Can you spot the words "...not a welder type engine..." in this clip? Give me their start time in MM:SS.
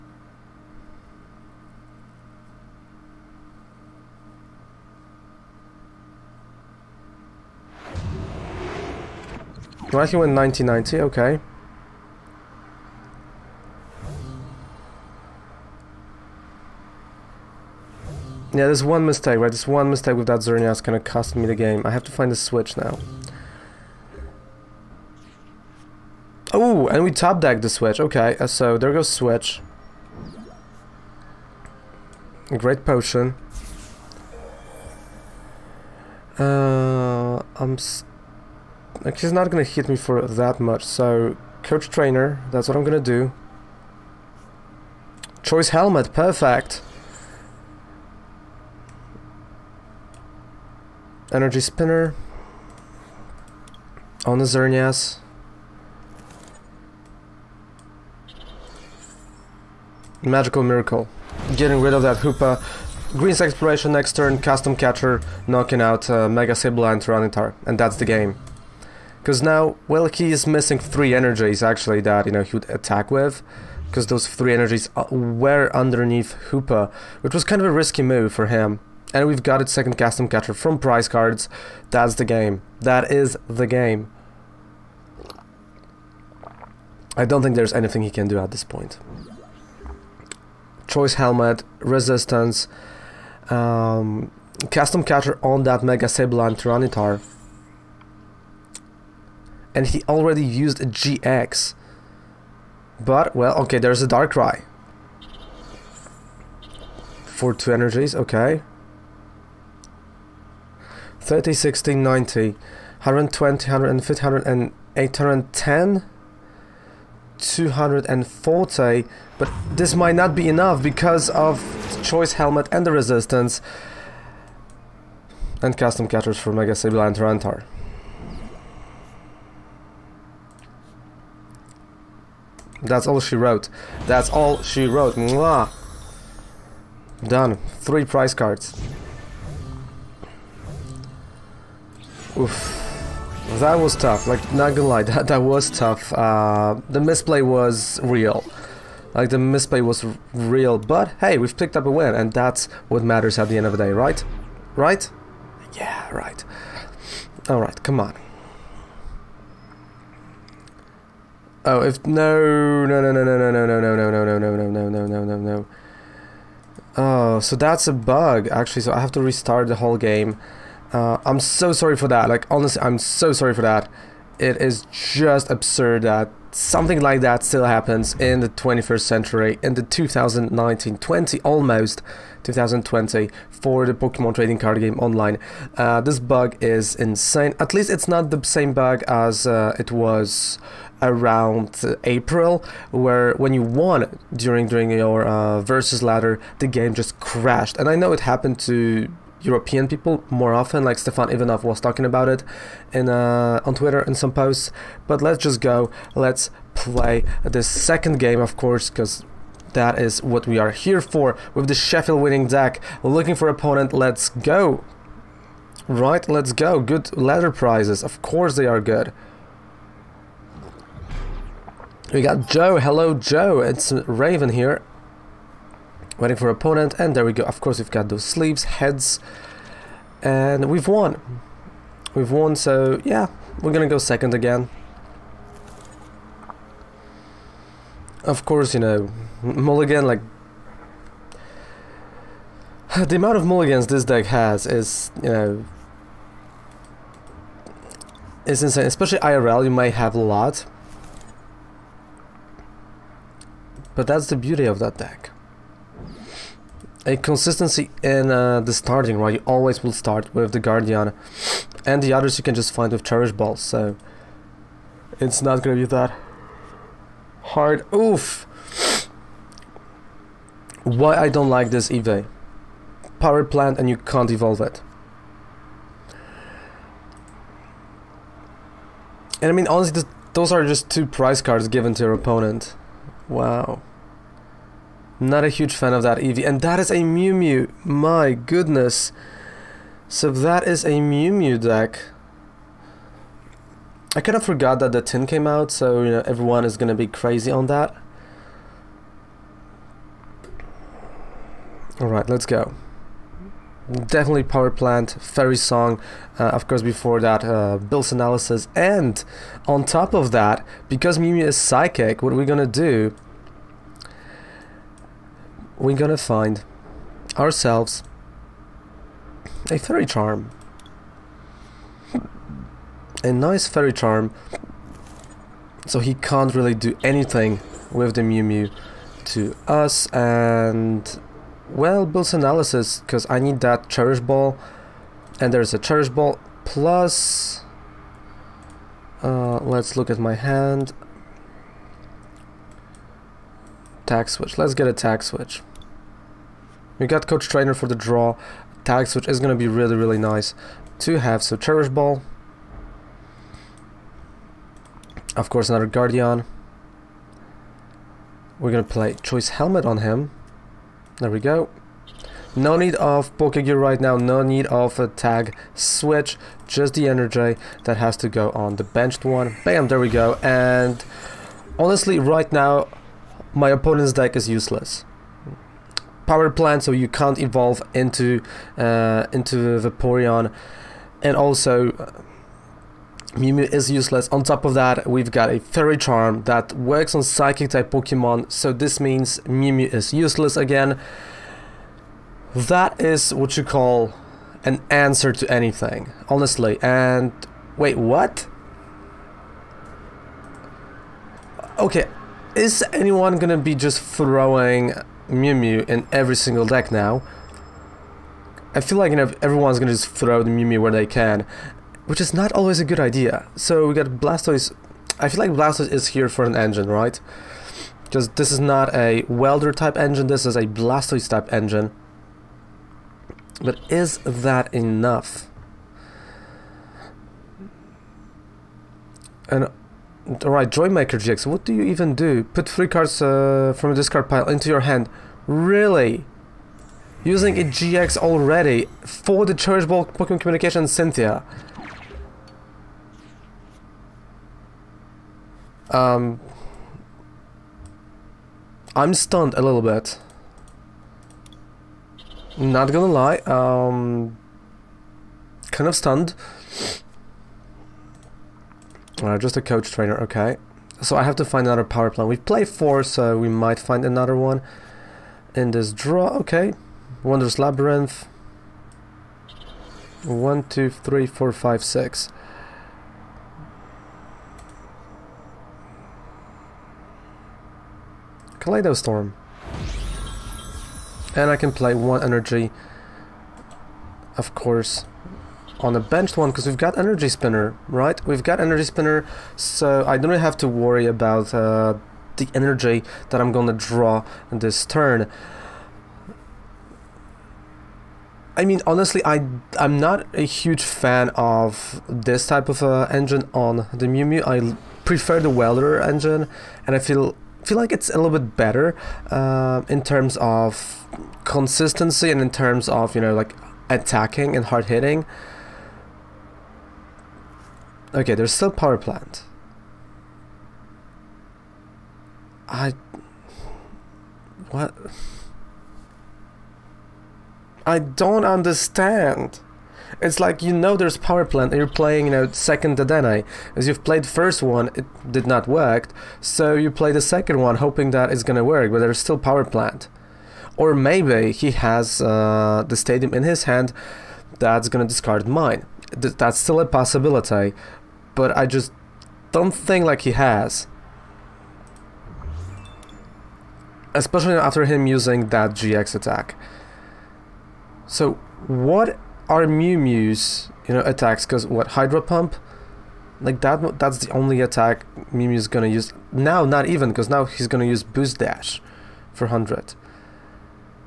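06:58.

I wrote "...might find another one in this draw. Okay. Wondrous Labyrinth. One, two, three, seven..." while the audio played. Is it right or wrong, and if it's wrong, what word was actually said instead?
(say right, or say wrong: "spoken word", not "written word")
wrong: "four", not "seven".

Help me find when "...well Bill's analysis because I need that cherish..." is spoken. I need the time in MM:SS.
05:31.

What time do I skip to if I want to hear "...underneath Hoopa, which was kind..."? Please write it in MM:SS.
01:15.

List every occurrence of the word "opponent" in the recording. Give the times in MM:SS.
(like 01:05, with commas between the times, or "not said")
03:33, 03:46, 04:42, 06:13.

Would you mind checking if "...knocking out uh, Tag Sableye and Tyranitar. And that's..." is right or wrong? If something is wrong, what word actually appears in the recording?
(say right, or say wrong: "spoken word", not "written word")
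wrong: "Mega", not "Tag".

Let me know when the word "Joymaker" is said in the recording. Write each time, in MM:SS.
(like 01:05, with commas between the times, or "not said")
07:10.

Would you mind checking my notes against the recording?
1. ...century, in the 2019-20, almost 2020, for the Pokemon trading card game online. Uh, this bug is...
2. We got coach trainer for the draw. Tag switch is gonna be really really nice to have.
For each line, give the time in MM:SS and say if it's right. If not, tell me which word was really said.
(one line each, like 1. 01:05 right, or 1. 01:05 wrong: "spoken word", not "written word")
1. 02:59 right
2. 05:46 right.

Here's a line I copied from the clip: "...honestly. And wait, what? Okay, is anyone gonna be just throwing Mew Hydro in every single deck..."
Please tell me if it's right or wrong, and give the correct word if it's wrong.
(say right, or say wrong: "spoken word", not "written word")
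wrong: "Mew", not "Hydro".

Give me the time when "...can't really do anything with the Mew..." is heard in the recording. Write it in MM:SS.
05:26.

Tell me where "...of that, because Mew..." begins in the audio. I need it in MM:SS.
05:10.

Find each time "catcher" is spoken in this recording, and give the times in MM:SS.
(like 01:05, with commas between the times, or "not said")
01:04, 01:20, 01:35, 02:06.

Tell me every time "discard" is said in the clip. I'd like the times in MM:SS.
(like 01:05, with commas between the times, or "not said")
07:13, 09:05.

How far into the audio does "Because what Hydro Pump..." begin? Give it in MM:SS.
09:21.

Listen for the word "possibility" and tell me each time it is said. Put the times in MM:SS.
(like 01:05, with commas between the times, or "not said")
09:06.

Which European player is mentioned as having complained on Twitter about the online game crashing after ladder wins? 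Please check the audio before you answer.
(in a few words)
Stefan Ivanov.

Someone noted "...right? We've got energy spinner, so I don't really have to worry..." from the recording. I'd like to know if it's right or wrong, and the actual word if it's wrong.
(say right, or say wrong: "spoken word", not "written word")
right.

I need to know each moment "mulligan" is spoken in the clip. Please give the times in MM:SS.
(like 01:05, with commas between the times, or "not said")
03:59, 04:03.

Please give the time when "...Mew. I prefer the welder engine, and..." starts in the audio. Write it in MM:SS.
08:24.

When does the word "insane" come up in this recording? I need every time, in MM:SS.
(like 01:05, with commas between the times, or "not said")
03:06, 04:08.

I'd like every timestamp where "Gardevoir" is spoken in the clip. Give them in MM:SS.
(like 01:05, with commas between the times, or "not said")
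04:20, 05:55.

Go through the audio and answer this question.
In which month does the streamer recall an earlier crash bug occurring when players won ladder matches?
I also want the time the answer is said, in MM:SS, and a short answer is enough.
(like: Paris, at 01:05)
April, at 03:12.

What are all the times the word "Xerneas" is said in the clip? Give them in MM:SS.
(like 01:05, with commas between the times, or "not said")
00:20, 00:54.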